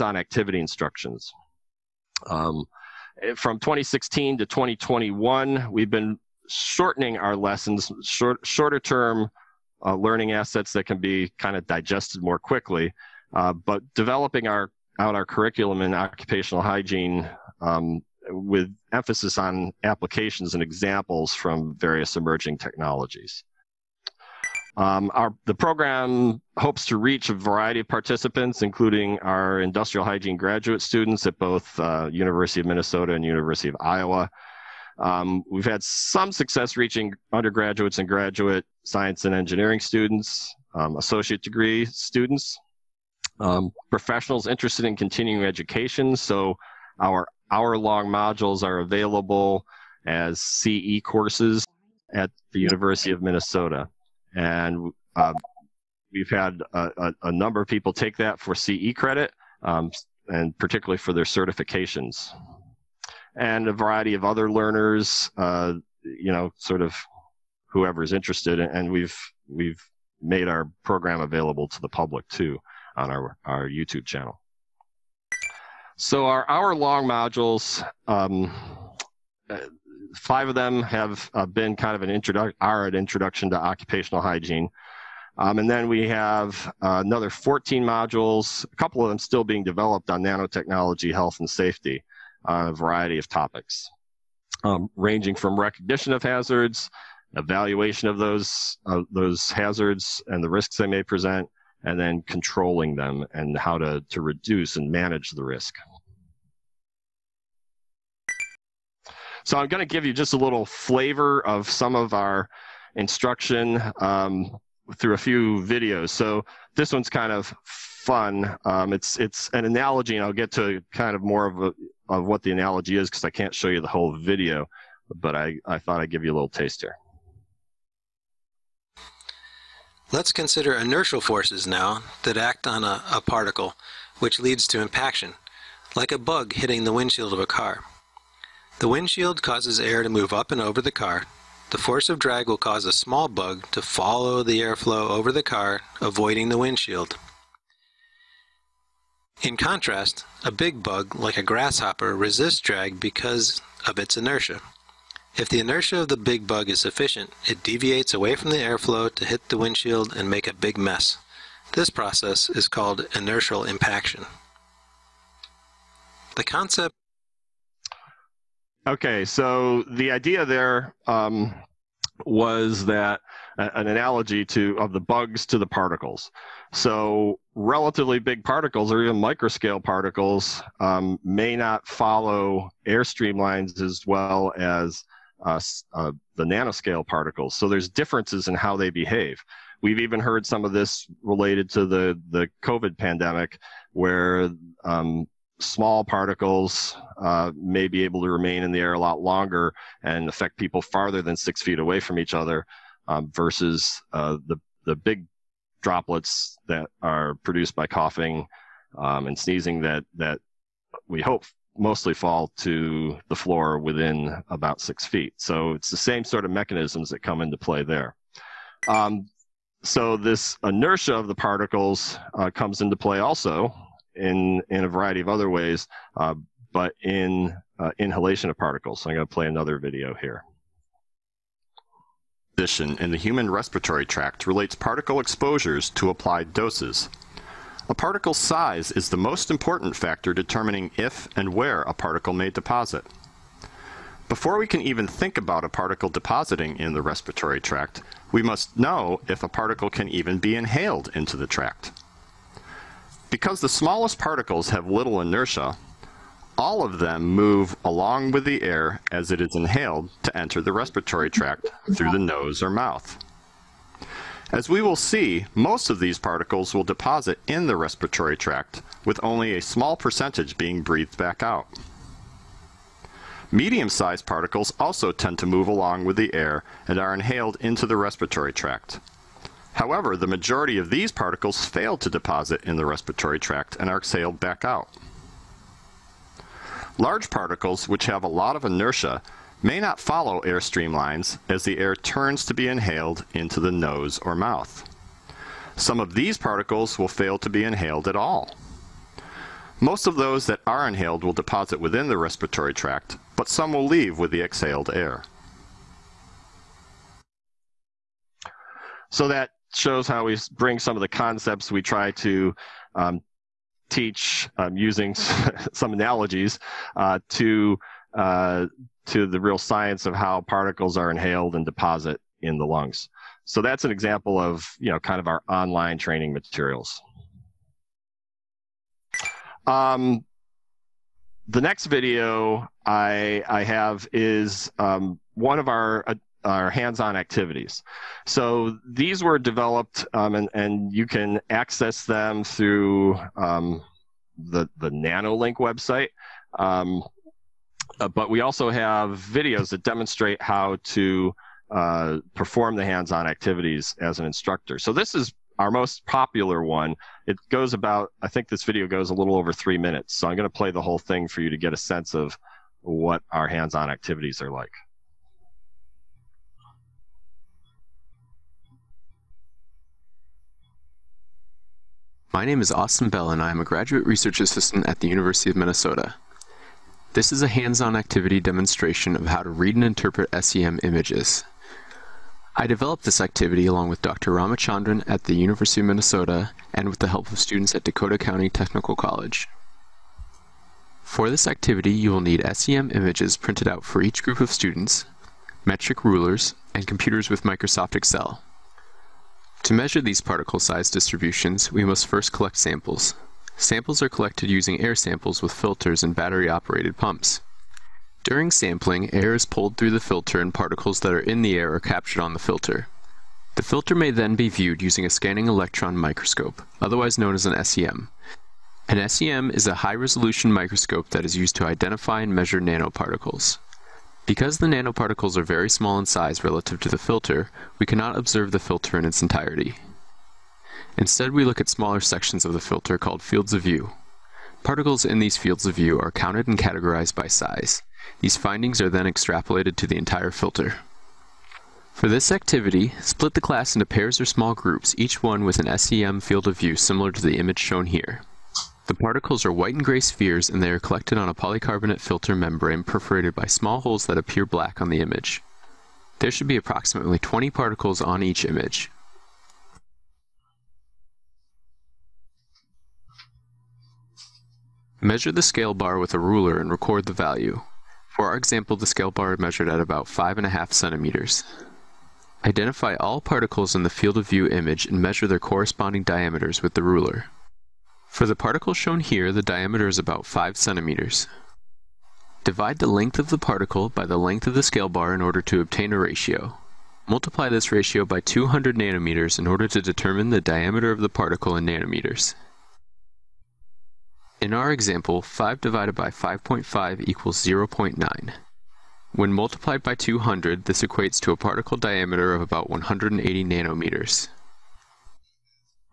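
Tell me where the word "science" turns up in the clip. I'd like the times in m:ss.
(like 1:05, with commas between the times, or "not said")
0:38, 5:19.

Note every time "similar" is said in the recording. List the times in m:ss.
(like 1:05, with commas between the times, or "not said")
7:26.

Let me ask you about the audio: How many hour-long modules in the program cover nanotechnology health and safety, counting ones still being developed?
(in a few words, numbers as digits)
14.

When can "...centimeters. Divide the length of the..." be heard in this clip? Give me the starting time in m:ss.
8:00.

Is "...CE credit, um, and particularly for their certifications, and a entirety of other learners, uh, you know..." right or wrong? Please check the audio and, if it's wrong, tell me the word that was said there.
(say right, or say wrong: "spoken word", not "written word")
wrong: "variety", not "entirety".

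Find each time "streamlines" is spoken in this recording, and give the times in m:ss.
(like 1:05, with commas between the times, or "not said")
3:03, 4:50.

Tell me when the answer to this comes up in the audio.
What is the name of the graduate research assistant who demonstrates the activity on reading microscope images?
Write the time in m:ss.
6:12.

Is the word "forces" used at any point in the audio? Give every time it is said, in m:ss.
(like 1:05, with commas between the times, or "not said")
2:11, 2:21.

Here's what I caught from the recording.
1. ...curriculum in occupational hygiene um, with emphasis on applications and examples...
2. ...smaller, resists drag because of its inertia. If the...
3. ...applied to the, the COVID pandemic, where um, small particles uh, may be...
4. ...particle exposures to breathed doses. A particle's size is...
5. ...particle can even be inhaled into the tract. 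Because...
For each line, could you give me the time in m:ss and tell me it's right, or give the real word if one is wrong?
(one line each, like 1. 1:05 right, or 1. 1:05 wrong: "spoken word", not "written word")
1. 0:15 right
2. 2:31 wrong: "grasshopper", not "smaller"
3. 3:11 wrong: "related", not "applied"
4. 3:54 wrong: "applied", not "breathed"
5. 4:09 right.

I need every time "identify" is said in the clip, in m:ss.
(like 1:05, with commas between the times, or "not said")
7:01, 7:52.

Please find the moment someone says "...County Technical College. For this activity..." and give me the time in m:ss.
6:28.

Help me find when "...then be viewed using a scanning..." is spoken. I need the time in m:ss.
6:54.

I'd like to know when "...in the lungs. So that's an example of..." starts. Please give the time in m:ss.
5:22.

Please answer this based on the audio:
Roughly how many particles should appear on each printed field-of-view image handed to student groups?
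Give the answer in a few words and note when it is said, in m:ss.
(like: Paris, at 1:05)
20, at 7:37.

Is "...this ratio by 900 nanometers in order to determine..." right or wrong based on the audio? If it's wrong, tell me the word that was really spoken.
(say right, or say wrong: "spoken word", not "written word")
wrong: "200", not "900".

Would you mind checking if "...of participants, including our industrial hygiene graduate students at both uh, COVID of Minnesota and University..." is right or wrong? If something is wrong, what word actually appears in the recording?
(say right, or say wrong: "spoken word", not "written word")
wrong: "University", not "COVID".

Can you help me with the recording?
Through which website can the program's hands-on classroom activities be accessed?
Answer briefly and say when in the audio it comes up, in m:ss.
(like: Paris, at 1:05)
NanoLink, at 5:44.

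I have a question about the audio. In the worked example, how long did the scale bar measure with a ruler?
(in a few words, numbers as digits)
5.5 centimeters.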